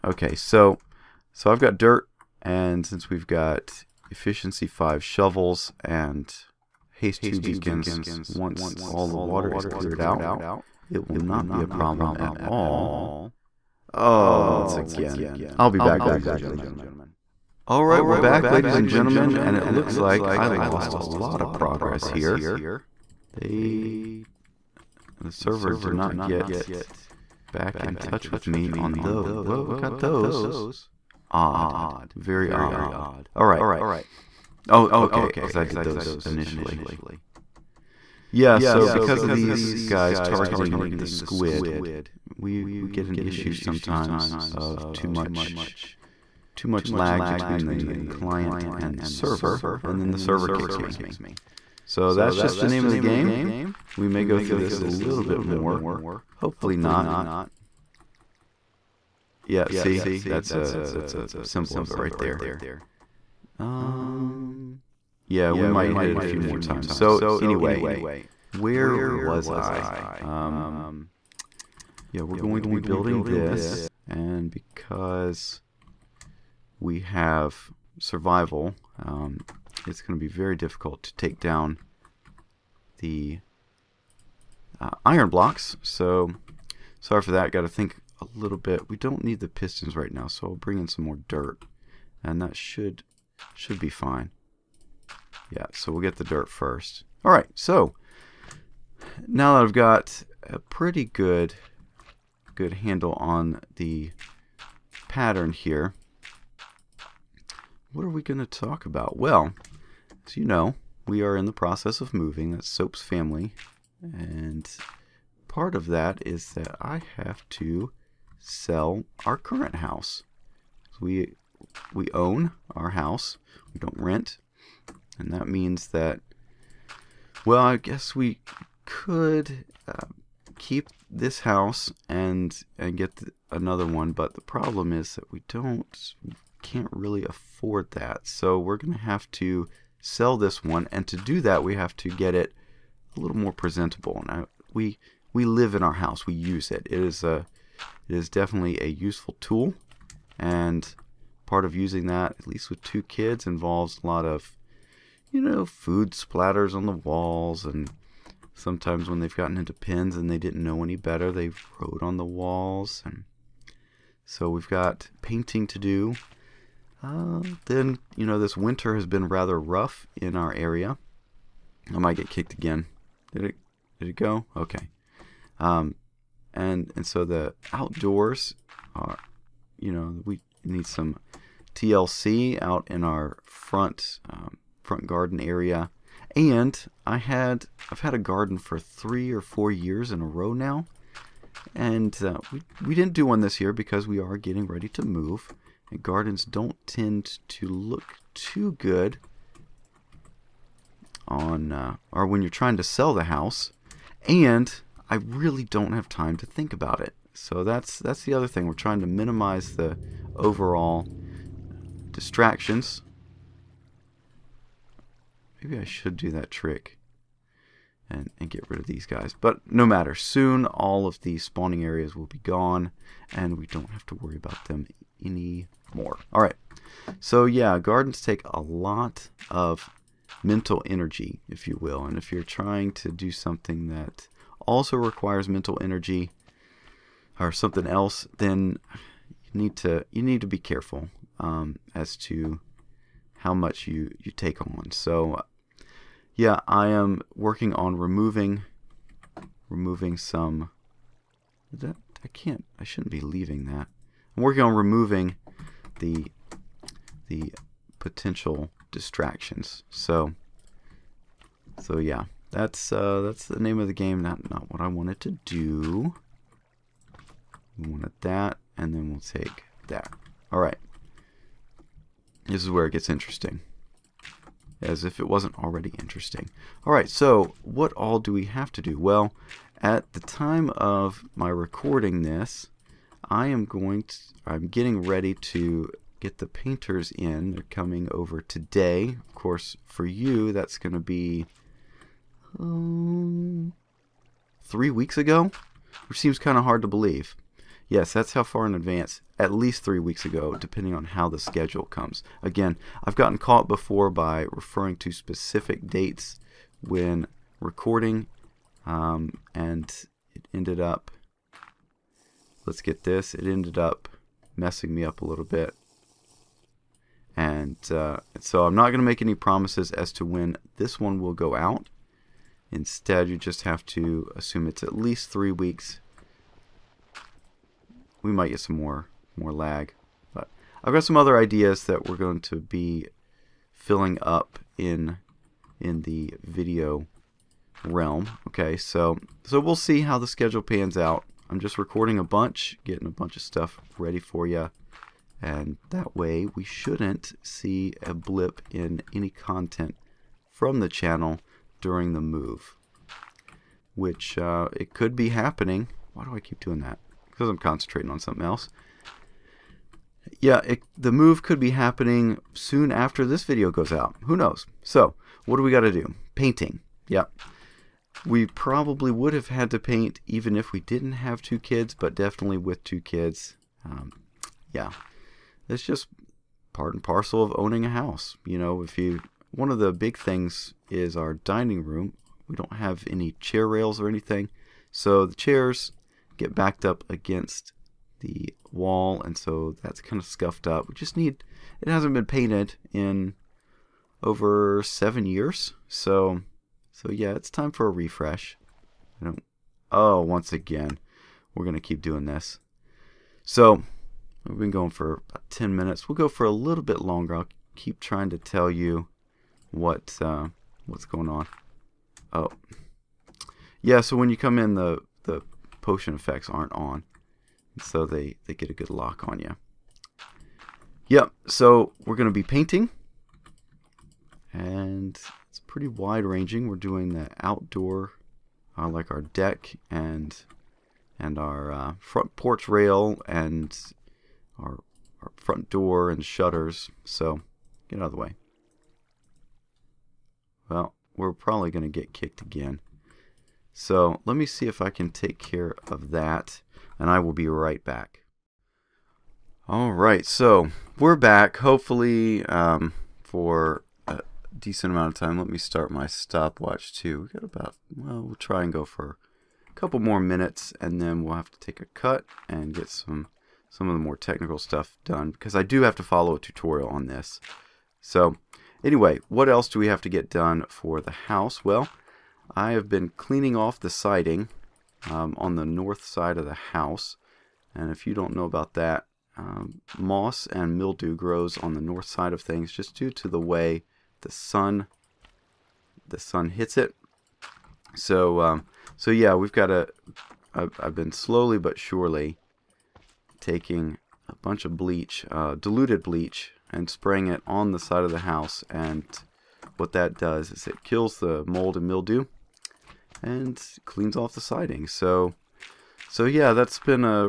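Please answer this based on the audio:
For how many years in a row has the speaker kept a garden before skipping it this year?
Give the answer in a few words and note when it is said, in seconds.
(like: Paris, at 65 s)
3 or 4, at 188 s.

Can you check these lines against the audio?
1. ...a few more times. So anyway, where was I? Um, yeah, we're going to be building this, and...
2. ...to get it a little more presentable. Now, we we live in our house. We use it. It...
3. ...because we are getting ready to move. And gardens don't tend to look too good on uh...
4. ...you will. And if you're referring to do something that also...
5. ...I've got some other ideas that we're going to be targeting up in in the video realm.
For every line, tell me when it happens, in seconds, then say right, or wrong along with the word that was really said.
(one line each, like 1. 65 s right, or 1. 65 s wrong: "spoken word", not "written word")
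1. 66 s right
2. 141 s right
3. 193 s right
4. 231 s wrong: "trying", not "referring"
5. 330 s wrong: "filling", not "targeting".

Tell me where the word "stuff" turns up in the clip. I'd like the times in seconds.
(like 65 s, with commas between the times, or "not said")
343 s, 464 s.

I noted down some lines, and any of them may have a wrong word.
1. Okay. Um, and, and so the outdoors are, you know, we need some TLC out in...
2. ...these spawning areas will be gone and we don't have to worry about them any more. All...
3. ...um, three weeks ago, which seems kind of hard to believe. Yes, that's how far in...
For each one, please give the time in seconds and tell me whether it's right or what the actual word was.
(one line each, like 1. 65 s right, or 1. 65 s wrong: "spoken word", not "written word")
1. 174 s right
2. 221 s right
3. 292 s right.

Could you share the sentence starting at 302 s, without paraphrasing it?
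Again, I've gotten caught before by referring to specific dates when recording, um, and it ended up let's get this.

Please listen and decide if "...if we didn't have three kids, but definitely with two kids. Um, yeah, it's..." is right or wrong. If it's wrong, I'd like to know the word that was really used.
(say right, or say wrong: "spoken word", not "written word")
wrong: "two", not "three".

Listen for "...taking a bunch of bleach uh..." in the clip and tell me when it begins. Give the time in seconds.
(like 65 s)
493 s.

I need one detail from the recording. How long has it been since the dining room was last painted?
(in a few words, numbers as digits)
Over 7 years.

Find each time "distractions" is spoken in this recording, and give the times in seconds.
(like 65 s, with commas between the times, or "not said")
212 s, 258 s.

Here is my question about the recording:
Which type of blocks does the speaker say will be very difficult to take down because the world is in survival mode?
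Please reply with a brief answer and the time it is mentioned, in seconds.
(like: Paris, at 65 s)
Iron blocks, at 85 s.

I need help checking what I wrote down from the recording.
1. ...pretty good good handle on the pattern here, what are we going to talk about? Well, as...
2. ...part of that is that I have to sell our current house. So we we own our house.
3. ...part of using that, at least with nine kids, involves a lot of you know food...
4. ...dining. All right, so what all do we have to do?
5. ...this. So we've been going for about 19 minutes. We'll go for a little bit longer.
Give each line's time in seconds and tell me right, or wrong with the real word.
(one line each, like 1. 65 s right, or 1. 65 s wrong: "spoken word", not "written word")
1. 100 s right
2. 115 s right
3. 151 s wrong: "two", not "nine"
4. 275 s wrong: "interesting", not "dining"
5. 402 s wrong: "10", not "19".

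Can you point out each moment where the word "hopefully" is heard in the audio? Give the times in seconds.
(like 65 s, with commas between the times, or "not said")
56 s, 451 s.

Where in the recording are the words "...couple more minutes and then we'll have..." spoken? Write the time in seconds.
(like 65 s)
459 s.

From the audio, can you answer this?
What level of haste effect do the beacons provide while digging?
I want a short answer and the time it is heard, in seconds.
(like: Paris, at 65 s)
Haste 2, at 6 s.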